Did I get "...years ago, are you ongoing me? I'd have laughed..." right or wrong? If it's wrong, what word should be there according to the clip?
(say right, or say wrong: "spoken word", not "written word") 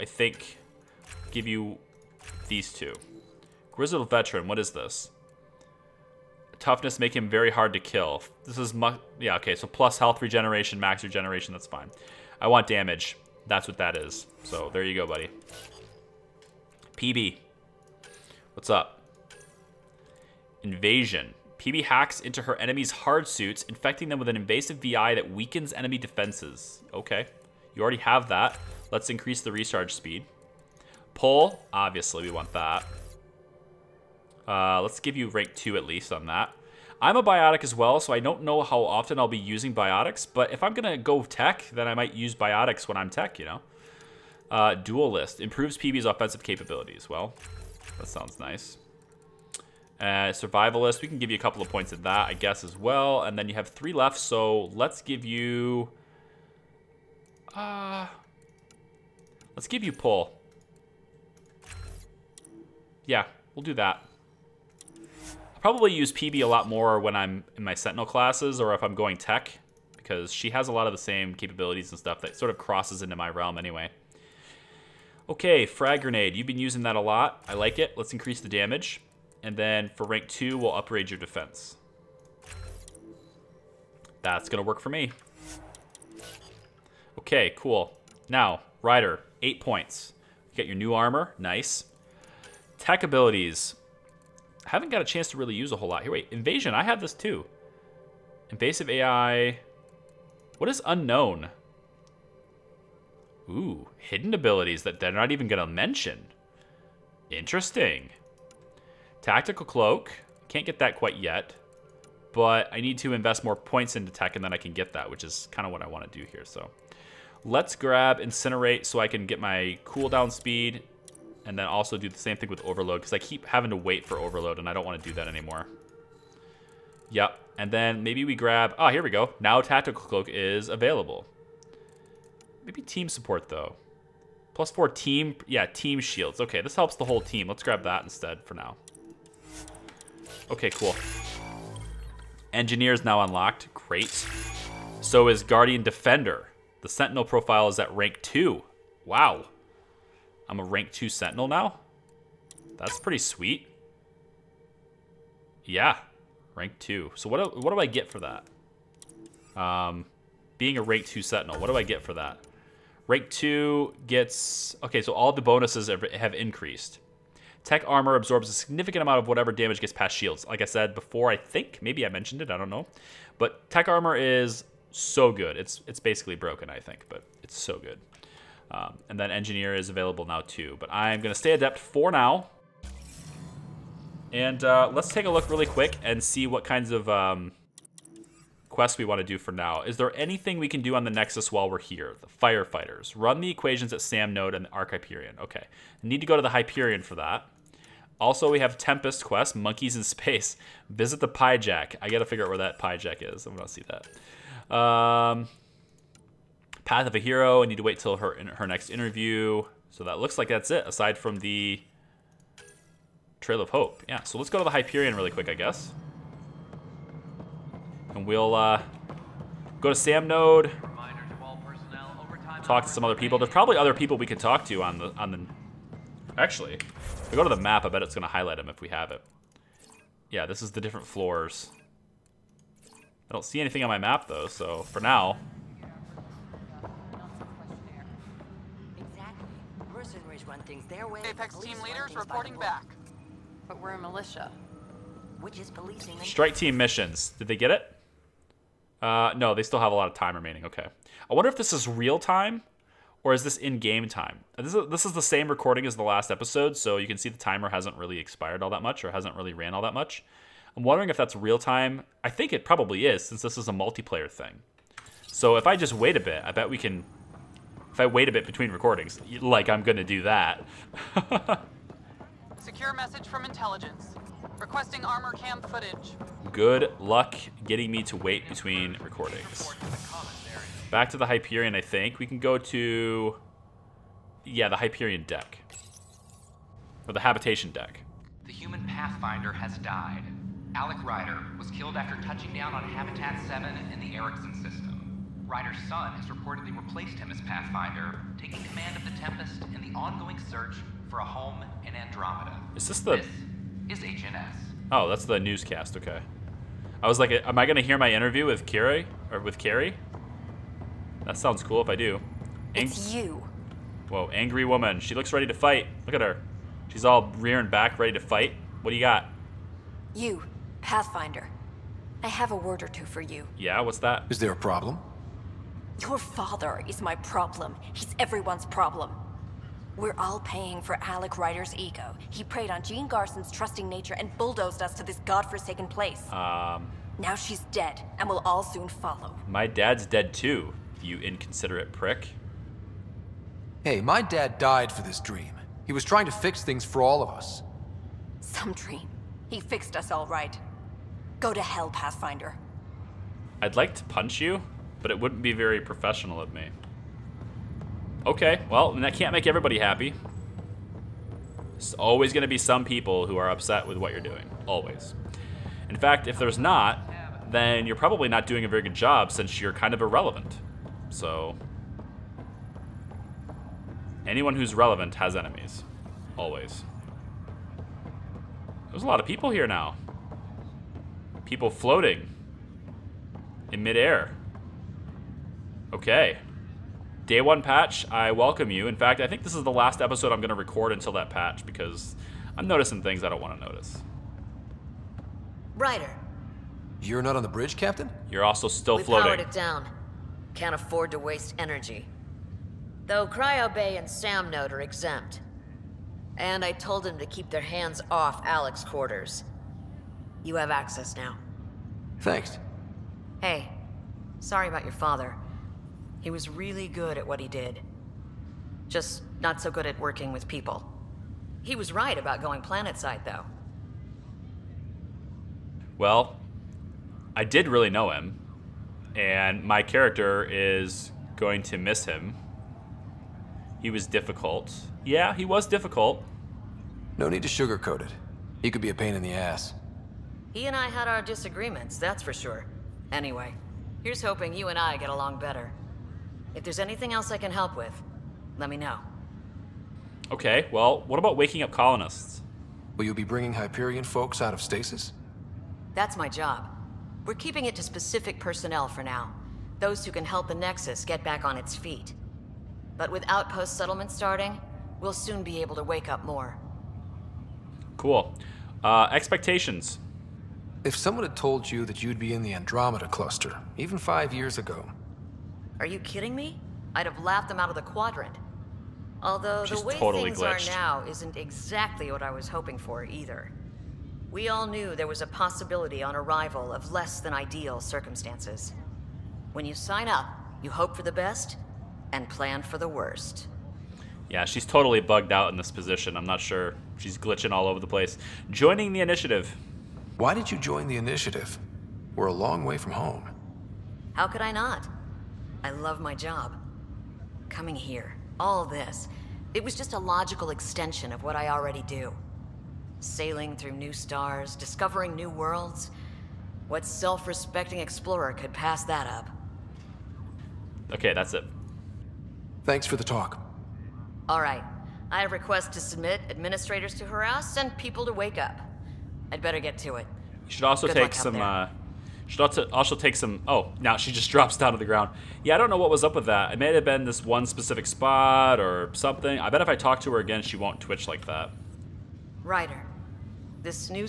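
wrong: "kidding", not "ongoing".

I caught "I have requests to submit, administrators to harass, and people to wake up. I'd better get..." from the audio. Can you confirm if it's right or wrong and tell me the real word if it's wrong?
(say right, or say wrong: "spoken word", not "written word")
right.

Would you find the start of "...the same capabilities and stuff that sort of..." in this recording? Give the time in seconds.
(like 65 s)
70 s.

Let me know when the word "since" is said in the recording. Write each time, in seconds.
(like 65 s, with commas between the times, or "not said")
263 s, 369 s.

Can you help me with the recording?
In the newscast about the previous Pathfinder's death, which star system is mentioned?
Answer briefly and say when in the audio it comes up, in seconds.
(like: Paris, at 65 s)
Erickson system, at 294 s.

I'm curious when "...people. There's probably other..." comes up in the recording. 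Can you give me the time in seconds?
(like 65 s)
223 s.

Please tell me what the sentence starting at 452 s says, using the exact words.
Will you be bringing Hyperion folks out of stasis?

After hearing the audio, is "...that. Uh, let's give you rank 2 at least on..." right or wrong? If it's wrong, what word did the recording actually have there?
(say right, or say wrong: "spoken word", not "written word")
right.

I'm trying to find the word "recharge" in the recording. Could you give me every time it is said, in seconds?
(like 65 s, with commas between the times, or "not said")
29 s.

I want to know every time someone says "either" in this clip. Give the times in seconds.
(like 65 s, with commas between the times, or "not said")
483 s.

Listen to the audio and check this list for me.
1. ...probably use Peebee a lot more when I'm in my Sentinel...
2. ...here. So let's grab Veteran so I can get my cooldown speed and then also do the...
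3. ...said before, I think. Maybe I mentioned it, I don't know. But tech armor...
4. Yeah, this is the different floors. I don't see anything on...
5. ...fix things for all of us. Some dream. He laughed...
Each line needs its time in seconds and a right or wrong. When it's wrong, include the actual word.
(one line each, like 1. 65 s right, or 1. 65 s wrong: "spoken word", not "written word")
1. 65 s right
2. 116 s wrong: "Incinerate", not "Veteran"
3. 170 s right
4. 230 s right
5. 346 s wrong: "fixed", not "laughed".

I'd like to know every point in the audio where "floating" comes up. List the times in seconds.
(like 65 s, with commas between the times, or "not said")
381 s, 399 s.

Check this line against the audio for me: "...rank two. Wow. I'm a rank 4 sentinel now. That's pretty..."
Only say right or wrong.
wrong.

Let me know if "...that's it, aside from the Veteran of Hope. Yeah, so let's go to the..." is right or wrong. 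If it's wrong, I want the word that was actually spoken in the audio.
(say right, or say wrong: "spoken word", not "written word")
wrong: "Trail", not "Veteran".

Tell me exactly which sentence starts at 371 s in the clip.
So, anyone who's relevant has enemies.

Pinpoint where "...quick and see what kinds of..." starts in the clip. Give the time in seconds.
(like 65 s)
185 s.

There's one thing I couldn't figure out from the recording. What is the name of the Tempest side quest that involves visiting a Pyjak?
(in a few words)
Monkeys in Space.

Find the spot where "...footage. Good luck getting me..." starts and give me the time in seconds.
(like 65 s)
275 s.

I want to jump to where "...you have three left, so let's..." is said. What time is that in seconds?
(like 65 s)
53 s.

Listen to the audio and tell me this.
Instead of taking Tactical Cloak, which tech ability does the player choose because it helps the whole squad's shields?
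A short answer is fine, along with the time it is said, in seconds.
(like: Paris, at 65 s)
Team support, at 132 s.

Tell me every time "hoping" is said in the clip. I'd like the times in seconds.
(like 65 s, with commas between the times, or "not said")
444 s, 482 s.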